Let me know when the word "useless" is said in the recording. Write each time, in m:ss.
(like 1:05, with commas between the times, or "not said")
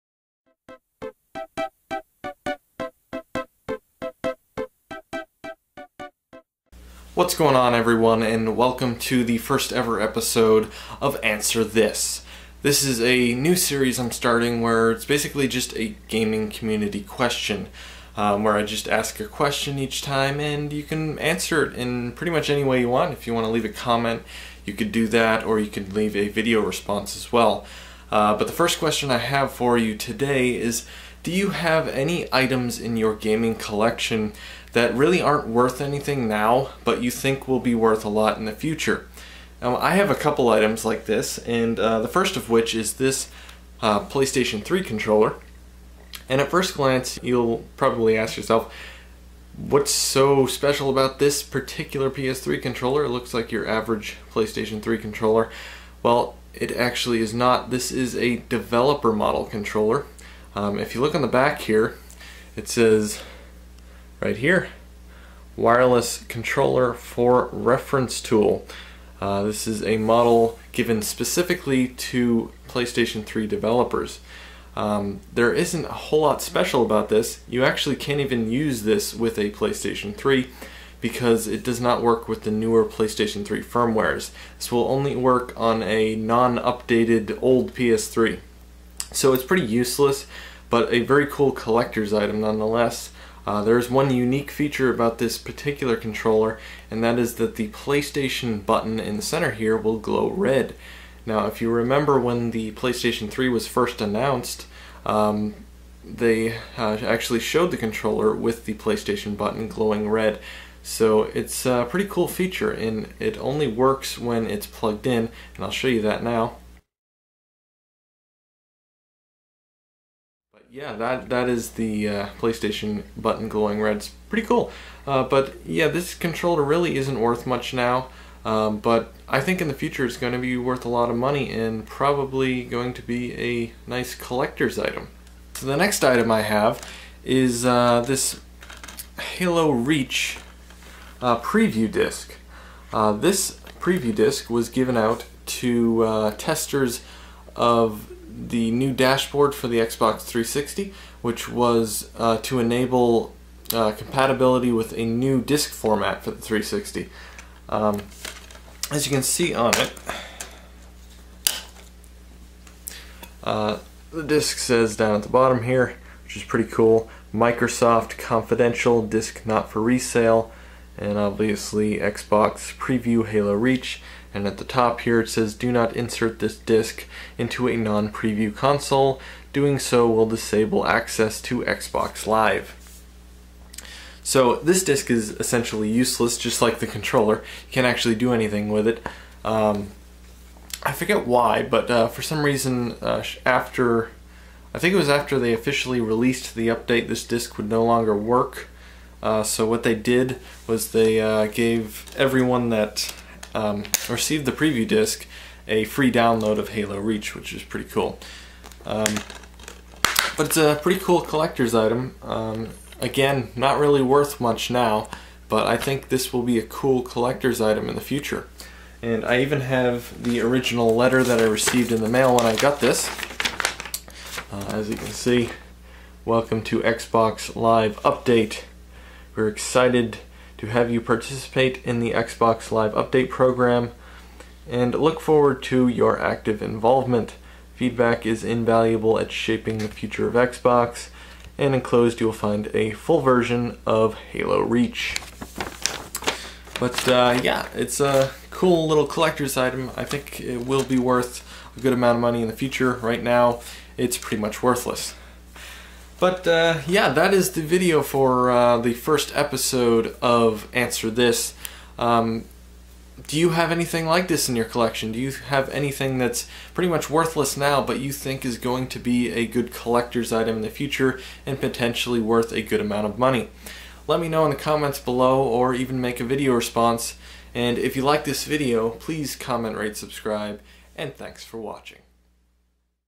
1:29, 3:05.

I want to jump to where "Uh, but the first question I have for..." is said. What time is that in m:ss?
0:28.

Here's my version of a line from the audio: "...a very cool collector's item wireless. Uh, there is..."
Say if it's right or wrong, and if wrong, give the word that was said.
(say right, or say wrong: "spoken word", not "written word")
wrong: "nonetheless", not "wireless".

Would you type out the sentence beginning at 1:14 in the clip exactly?
Um, there isn't a whole lot special about this.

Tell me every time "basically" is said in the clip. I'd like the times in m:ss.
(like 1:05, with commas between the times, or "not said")
0:15.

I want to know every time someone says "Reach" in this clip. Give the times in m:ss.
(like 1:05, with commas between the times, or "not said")
2:19, 2:53, 3:26, 4:04.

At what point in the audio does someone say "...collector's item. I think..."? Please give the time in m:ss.
4:09.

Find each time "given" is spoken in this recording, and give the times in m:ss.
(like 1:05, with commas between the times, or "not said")
1:10, 2:24.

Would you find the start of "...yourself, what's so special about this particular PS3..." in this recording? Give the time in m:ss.
0:48.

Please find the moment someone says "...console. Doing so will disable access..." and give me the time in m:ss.
2:58.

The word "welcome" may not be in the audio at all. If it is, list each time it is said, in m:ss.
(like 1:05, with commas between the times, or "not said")
0:08, 3:46.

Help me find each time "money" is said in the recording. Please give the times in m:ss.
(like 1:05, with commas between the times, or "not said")
2:11, 4:12, 4:33.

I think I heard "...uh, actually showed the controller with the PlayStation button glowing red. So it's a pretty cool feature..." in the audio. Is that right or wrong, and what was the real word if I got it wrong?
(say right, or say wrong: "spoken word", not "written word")
right.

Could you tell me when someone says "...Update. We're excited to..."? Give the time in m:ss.
3:48.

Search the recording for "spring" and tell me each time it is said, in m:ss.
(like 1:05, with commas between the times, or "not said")
not said.